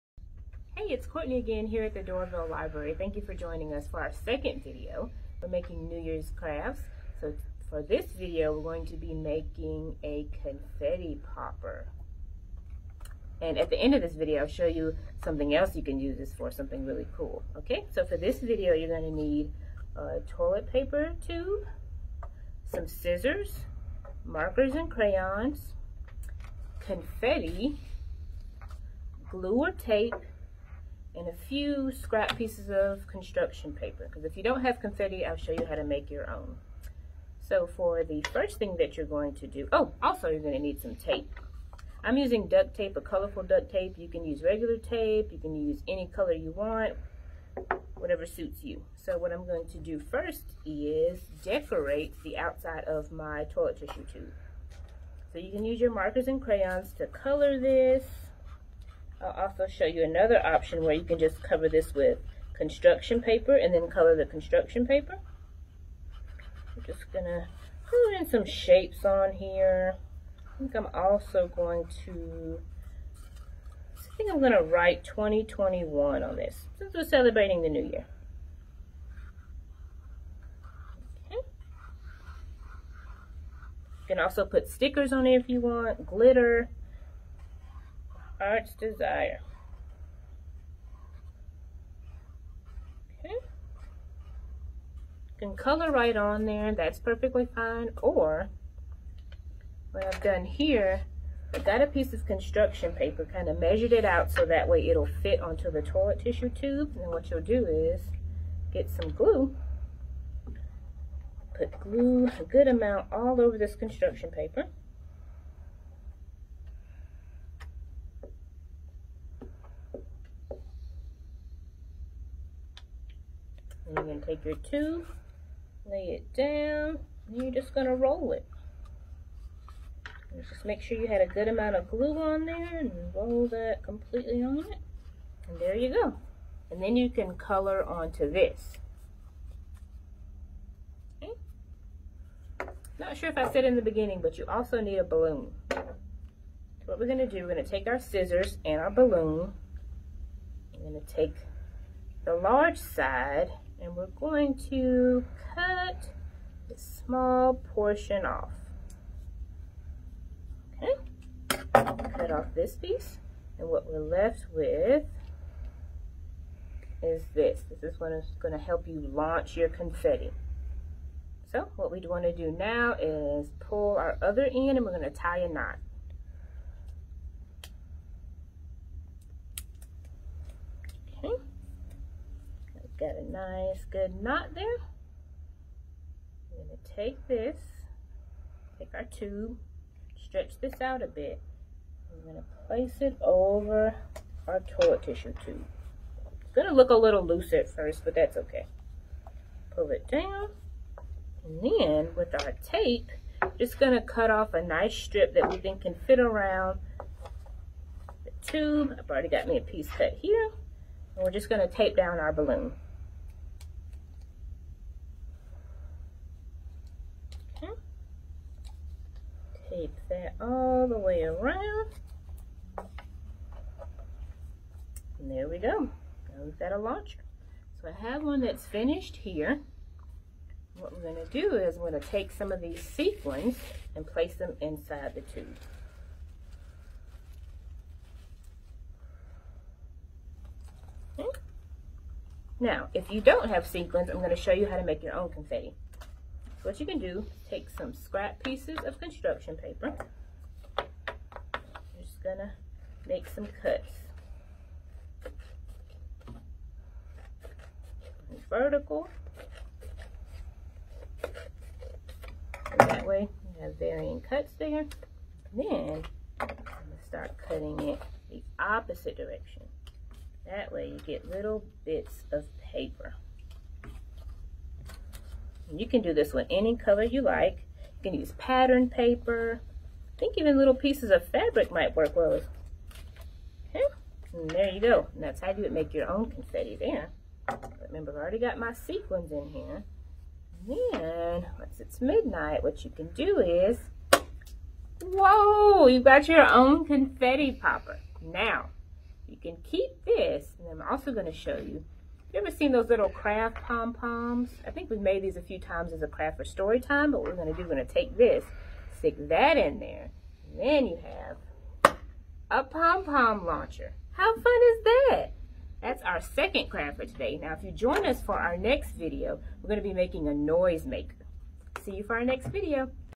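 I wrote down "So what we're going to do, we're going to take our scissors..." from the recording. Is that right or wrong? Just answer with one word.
right.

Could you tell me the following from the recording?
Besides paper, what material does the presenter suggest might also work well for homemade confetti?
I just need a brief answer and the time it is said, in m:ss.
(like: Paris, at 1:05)
fabric, at 4:41.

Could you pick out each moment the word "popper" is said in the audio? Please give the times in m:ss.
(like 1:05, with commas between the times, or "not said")
0:11, 4:57.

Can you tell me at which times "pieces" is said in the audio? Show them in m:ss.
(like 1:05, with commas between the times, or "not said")
0:32, 1:41, 2:42, 3:29, 4:08, 4:40.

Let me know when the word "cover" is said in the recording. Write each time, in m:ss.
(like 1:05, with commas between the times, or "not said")
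1:01.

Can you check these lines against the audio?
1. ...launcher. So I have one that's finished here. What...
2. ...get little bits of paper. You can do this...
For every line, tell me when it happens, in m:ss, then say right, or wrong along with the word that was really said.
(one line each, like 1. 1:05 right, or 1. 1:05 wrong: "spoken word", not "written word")
1. 3:46 right
2. 4:31 right.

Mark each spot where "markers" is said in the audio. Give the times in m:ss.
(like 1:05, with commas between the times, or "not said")
0:24, 0:55.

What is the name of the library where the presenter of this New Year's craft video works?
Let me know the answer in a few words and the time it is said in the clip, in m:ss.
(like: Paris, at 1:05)
Doraville Library, at 0:01.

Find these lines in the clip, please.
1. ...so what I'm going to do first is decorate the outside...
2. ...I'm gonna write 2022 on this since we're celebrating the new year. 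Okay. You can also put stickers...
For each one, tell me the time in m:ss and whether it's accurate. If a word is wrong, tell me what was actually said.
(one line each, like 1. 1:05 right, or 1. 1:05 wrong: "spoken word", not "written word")
1. 0:48 right
2. 1:14 wrong: "2021", not "2022".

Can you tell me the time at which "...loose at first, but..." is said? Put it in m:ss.
3:17.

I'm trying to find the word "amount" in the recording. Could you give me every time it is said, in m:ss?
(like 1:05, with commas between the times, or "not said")
1:52, 2:11.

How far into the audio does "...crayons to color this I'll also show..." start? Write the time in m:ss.
0:56.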